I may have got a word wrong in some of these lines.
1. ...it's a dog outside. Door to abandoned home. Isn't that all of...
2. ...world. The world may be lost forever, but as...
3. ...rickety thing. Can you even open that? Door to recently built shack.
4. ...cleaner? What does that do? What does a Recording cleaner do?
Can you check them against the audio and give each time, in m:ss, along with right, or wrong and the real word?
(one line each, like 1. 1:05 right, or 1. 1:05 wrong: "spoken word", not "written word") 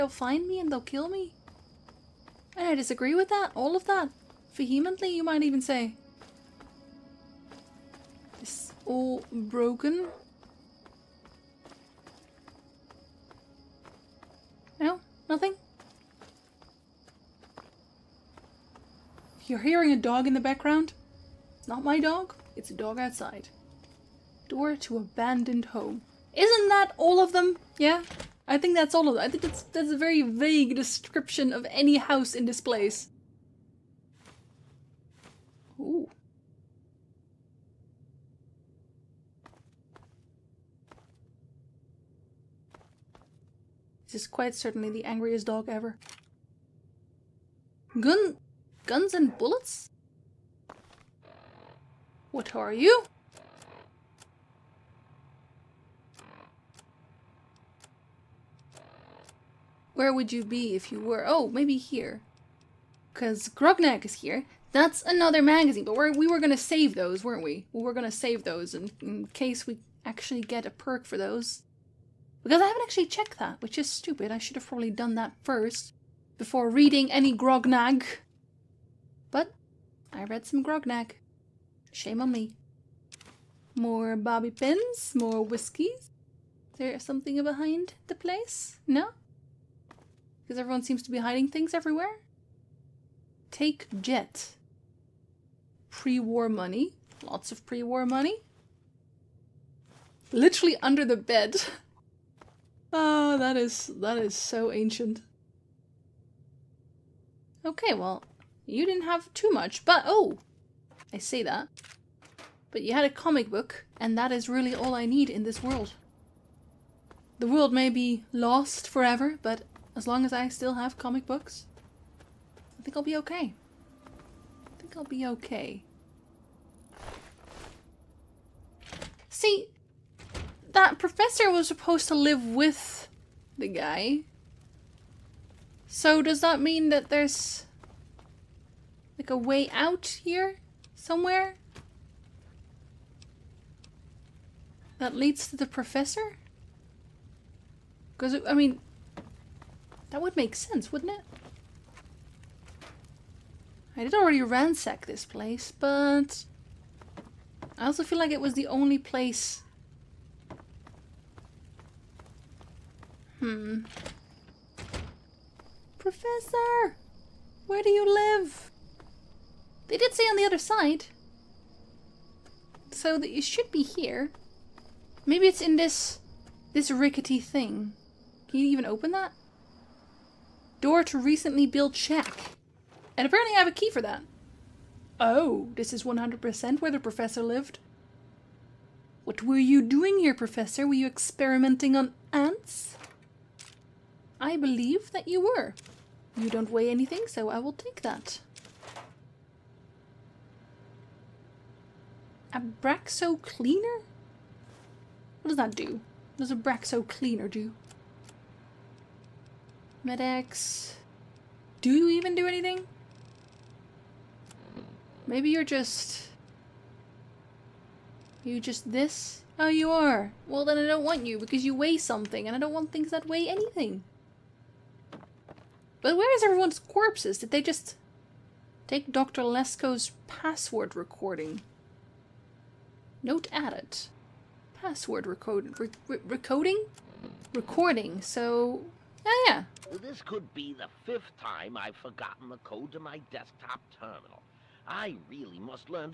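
1. 0:22 right
2. 1:55 right
3. 2:56 right
4. 3:23 wrong: "Braxo", not "Recording".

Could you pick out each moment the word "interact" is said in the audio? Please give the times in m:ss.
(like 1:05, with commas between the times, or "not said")
not said.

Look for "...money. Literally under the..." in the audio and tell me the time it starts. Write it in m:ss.
1:38.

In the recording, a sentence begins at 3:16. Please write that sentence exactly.
You don't weigh anything, so I will take that.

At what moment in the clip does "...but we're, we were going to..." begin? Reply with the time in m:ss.
1:05.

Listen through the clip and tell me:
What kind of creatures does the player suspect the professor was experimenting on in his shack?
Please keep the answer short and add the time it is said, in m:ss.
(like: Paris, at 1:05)
Ants, at 3:12.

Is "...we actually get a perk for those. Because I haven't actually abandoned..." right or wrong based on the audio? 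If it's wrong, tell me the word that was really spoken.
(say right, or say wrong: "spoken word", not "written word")
wrong: "checked", not "abandoned".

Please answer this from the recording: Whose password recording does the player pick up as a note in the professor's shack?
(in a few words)
Dr. Lesko.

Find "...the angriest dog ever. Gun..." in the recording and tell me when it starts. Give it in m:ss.
0:44.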